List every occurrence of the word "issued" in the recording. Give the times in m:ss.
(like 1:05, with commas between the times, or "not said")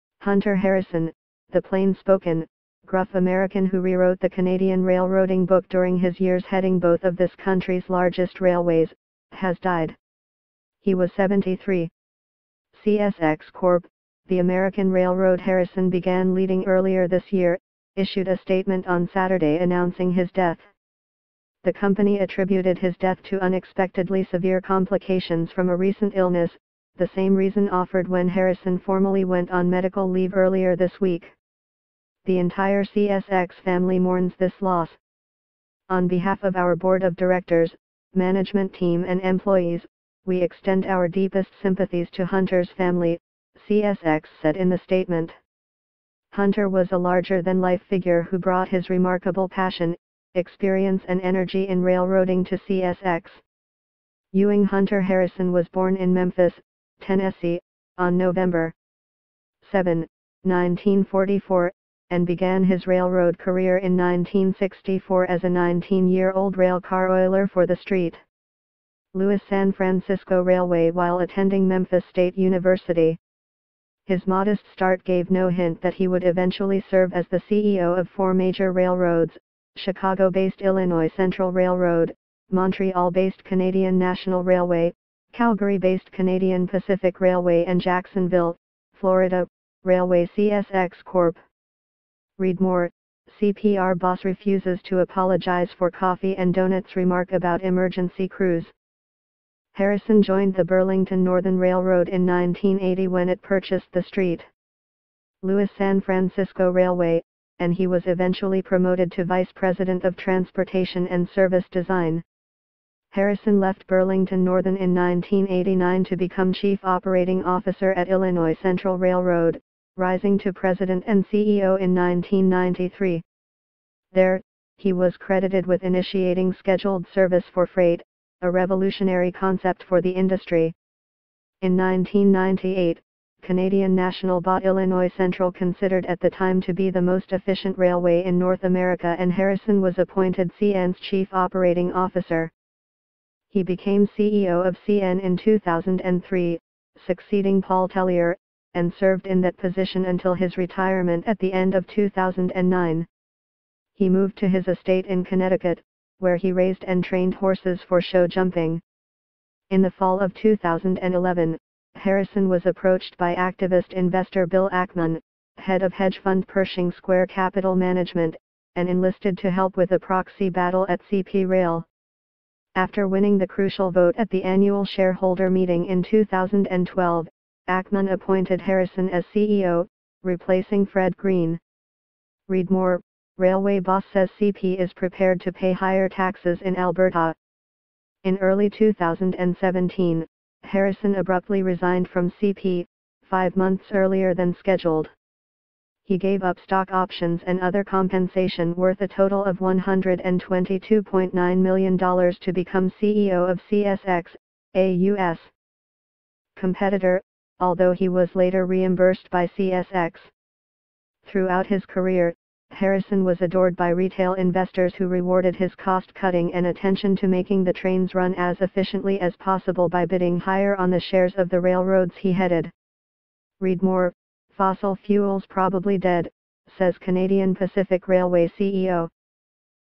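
0:17.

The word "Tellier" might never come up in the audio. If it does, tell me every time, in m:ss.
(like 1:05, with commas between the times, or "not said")
2:27.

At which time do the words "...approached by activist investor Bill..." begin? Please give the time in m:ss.
2:42.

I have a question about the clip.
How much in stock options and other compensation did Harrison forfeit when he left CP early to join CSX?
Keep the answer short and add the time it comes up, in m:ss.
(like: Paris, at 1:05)
$122.9 million, at 3:19.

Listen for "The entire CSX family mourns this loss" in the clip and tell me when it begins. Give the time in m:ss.
0:32.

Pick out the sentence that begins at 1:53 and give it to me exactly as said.
Harrison left Burlington Northern in 1989 to become Chief Operating Officer at Illinois Central Railroad, rising to President and CEO in 1993.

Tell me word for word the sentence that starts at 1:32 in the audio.
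Read more, CPR boss refuses to apologize for coffee and donuts remark about emergency crews.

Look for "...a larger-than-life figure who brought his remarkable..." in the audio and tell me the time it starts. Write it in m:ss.
0:46.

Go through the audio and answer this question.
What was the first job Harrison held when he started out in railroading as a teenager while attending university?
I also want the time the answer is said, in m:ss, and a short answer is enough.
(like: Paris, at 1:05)
railcar oiler, at 1:06.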